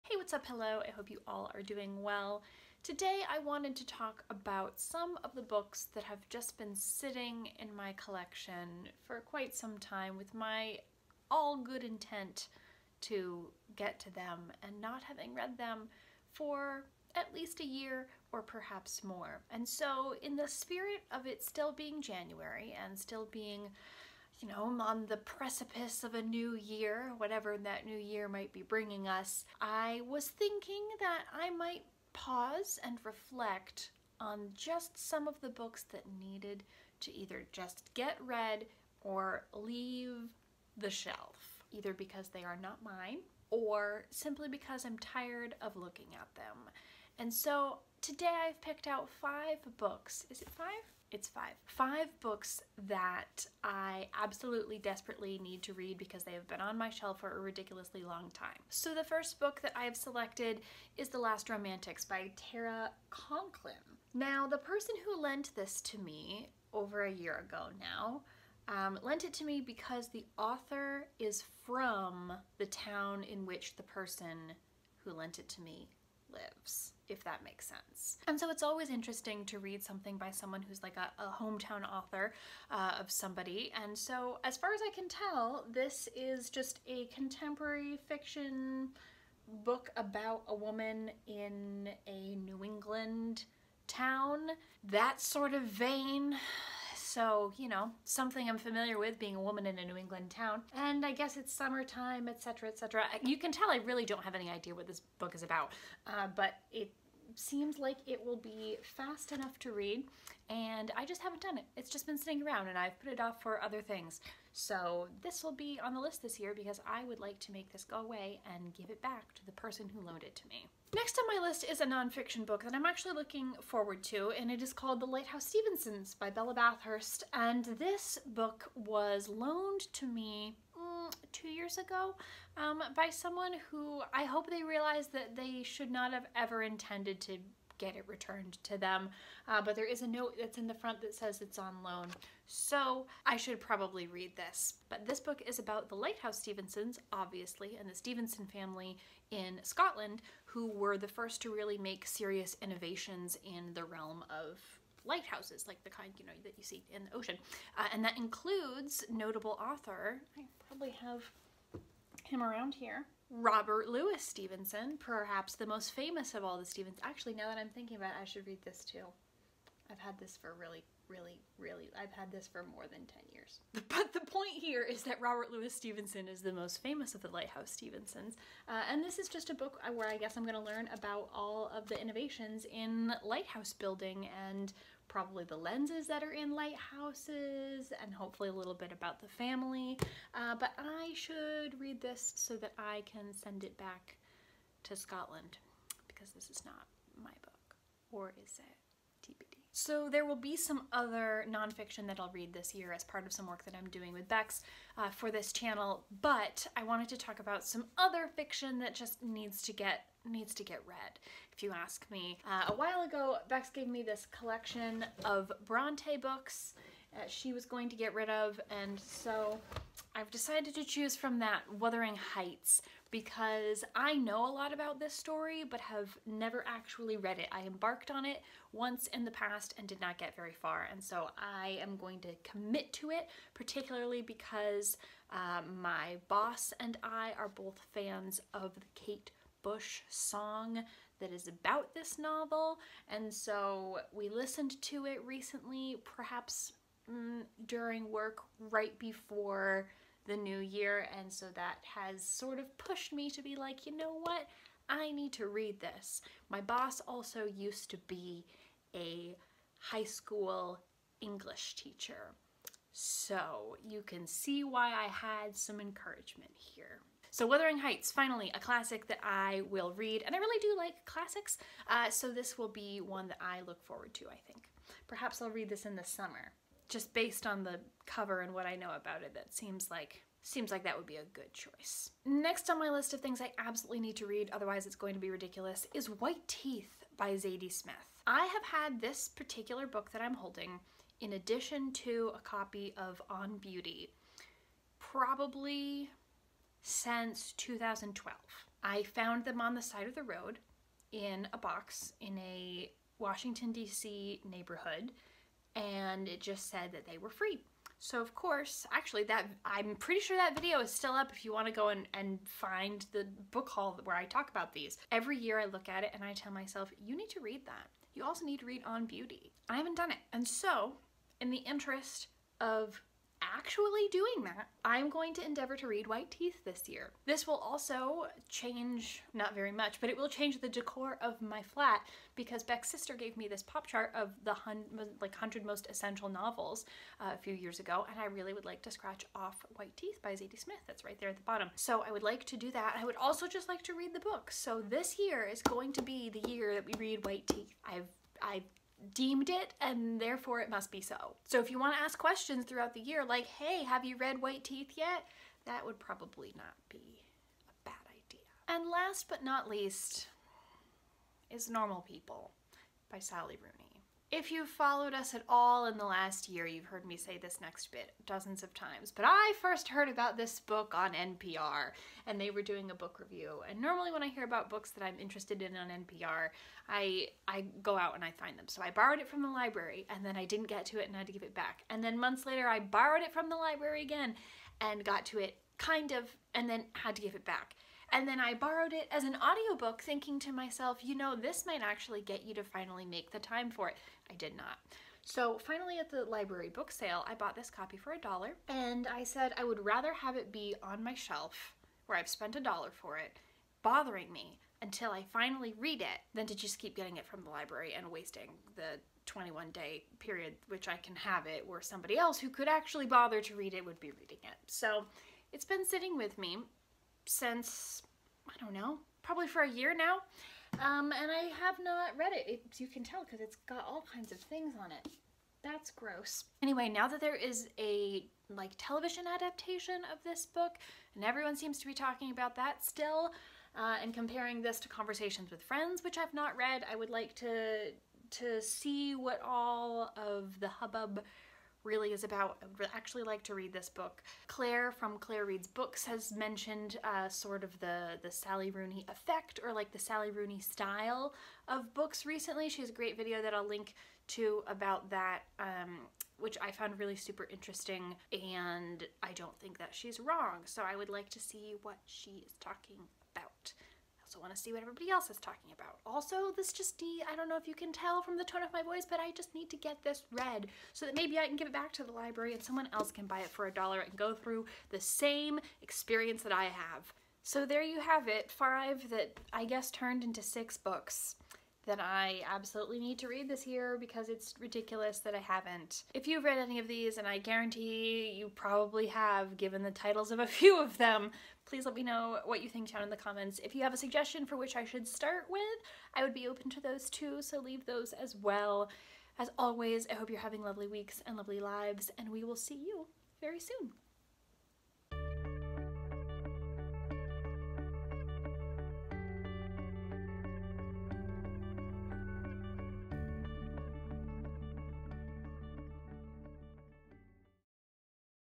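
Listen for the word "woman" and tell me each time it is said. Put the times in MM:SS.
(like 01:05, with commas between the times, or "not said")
01:30, 01:39.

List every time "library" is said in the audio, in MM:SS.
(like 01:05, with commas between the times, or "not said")
06:19, 06:23, 06:36, 06:47, 07:52.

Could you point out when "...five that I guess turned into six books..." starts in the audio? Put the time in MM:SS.
07:58.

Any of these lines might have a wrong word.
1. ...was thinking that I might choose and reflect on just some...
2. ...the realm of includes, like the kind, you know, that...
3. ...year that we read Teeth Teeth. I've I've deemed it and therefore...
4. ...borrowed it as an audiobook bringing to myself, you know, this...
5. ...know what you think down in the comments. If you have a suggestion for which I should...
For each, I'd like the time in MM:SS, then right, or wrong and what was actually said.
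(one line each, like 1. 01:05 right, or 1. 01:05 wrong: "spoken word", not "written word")
1. 00:30 wrong: "pause", not "choose"
2. 02:33 wrong: "lighthouses", not "includes"
3. 05:46 wrong: "White", not "Teeth"
4. 06:28 wrong: "thinking", not "bringing"
5. 08:12 right.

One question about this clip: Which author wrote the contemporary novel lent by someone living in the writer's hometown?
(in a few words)
Tara Conklin.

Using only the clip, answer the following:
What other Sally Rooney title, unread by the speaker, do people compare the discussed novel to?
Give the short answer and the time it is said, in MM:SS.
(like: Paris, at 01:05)
Conversations with Friends, at 07:14.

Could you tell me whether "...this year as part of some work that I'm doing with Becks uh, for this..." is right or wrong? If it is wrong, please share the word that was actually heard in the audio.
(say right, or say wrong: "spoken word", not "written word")
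right.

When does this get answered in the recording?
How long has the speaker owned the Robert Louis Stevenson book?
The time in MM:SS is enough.
02:52.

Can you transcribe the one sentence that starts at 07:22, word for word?
I would actually like to read this book.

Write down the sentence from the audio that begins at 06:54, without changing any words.
So it's been sitting with me since, I don't know, probably for a year now.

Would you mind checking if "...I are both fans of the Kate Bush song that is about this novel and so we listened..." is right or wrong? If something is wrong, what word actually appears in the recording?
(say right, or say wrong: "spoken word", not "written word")
right.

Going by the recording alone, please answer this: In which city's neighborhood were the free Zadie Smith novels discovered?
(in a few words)
Washington DC.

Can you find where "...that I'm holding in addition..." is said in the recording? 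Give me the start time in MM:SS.
04:50.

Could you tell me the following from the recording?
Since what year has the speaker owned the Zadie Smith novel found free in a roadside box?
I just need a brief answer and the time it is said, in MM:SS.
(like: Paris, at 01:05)
2012, at 04:57.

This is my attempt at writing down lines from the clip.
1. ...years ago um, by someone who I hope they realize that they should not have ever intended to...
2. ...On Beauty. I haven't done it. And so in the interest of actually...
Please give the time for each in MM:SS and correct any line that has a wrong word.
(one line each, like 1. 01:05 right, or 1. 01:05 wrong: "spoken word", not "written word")
1. 02:11 right
2. 05:18 right.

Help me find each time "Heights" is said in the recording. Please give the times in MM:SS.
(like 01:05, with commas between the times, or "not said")
03:42, 04:27.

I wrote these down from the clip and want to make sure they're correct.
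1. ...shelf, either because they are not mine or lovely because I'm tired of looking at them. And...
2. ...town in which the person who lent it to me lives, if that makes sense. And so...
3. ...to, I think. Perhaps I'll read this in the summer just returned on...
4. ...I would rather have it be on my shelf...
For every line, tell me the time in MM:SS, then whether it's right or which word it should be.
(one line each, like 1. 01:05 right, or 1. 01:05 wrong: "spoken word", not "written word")
1. 00:40 wrong: "simply", not "lovely"
2. 01:12 right
3. 04:34 wrong: "based", not "returned"
4. 06:39 right.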